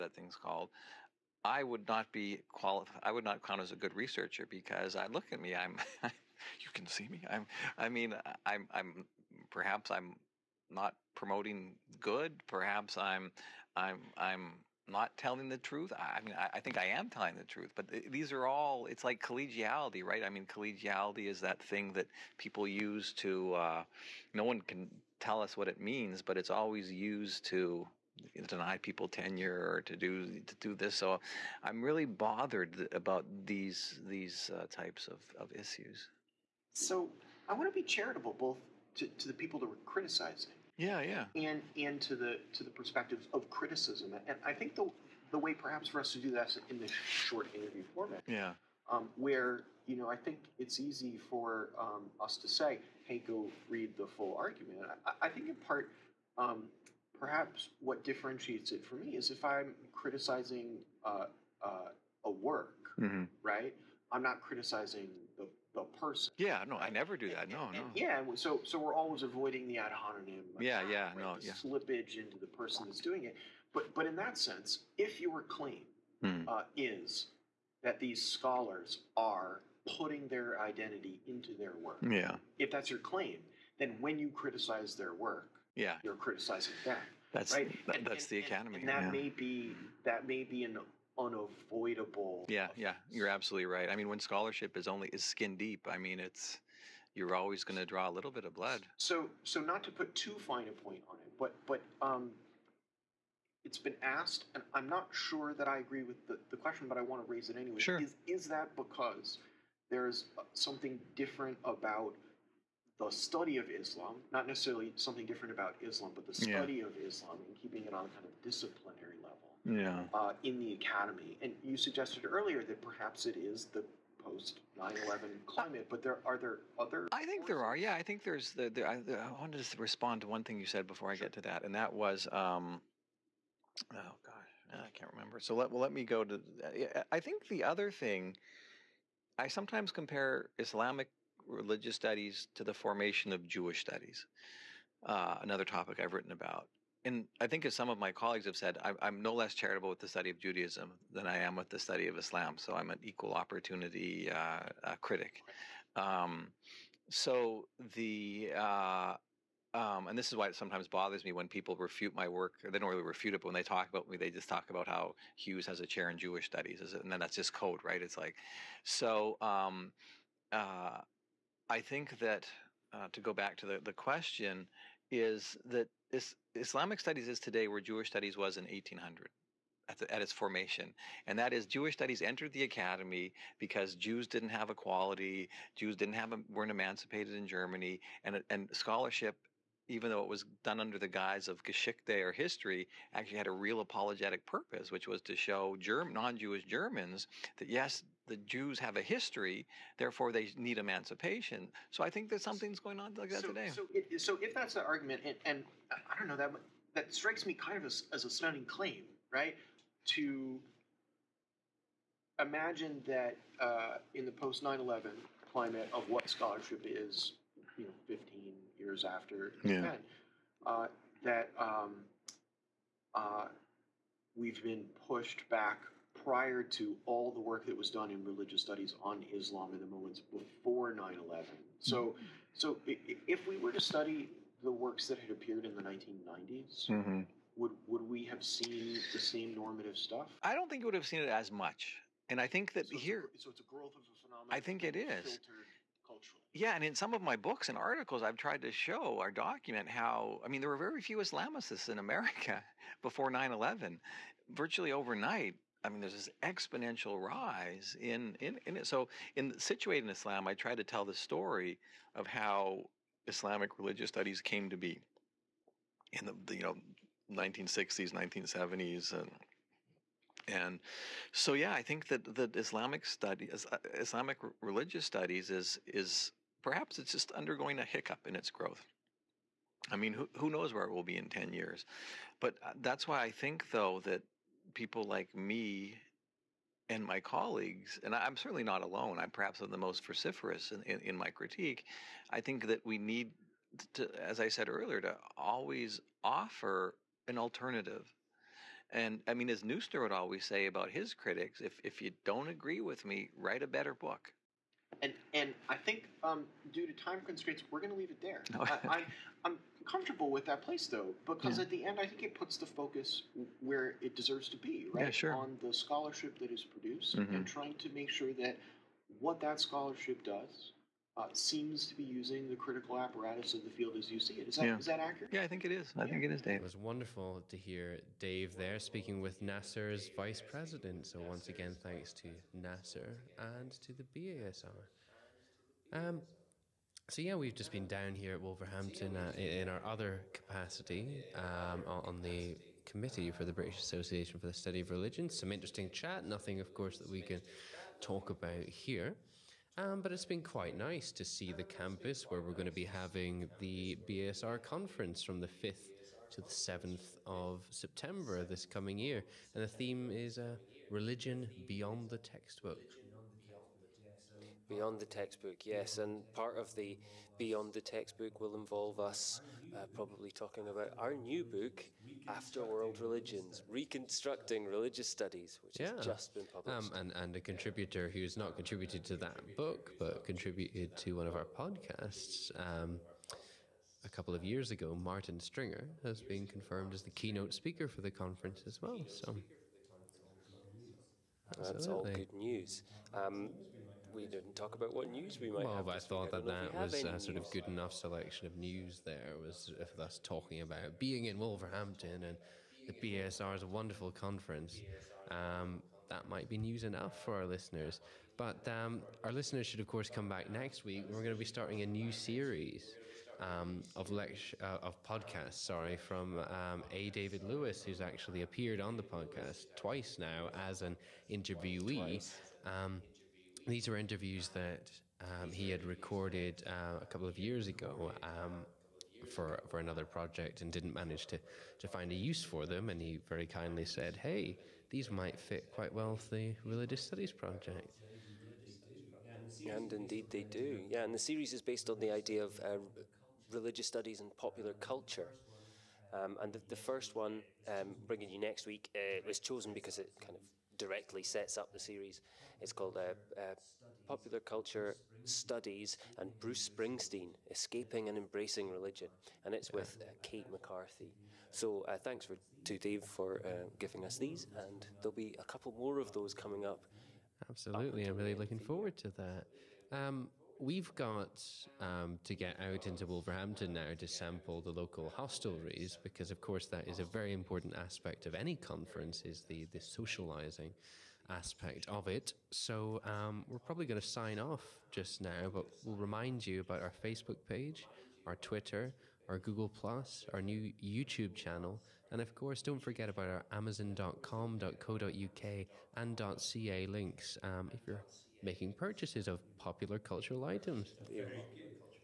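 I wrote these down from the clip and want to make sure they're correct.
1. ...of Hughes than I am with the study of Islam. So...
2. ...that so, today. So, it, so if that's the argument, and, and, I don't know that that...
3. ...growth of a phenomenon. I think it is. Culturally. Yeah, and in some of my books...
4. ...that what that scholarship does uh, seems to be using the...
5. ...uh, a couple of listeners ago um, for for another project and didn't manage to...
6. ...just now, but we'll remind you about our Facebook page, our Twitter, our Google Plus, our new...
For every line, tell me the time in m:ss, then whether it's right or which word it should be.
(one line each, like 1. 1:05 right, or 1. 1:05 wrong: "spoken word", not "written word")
1. 2:30 wrong: "Judaism", not "Hughes"
2. 3:23 right
3. 4:03 right
4. 5:18 right
5. 7:06 wrong: "years", not "listeners"
6. 8:04 right.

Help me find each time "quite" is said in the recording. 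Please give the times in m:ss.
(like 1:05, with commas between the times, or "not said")
5:50, 7:15.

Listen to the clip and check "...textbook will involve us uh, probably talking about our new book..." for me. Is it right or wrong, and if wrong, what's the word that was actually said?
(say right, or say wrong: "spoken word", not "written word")
right.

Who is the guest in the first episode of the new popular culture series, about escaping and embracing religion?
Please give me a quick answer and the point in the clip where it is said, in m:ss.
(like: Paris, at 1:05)
Kate McCarthy, at 7:40.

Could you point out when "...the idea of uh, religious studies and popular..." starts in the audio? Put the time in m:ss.
7:21.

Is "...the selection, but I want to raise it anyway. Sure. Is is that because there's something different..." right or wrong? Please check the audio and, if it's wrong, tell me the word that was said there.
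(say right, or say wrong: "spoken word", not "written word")
wrong: "question", not "selection".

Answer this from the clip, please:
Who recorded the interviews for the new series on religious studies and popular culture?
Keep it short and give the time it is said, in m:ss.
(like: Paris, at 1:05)
David Lewis, at 6:57.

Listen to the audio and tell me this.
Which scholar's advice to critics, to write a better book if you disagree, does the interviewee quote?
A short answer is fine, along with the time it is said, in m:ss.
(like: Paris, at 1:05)
Neusner, at 4:59.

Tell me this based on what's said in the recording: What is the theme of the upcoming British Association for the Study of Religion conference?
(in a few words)
Religion Beyond the Textbook.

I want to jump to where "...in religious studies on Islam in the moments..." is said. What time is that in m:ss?
3:48.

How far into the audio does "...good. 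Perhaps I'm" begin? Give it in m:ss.
0:11.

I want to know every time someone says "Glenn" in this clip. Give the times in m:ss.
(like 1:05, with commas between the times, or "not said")
not said.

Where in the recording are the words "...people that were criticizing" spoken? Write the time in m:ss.
0:39.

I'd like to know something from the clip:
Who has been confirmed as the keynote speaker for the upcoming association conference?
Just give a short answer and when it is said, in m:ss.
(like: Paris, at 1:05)
Martin Stringer, at 6:24.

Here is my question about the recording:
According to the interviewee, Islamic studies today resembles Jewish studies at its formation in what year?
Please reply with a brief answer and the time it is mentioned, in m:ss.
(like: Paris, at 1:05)
1800, at 2:58.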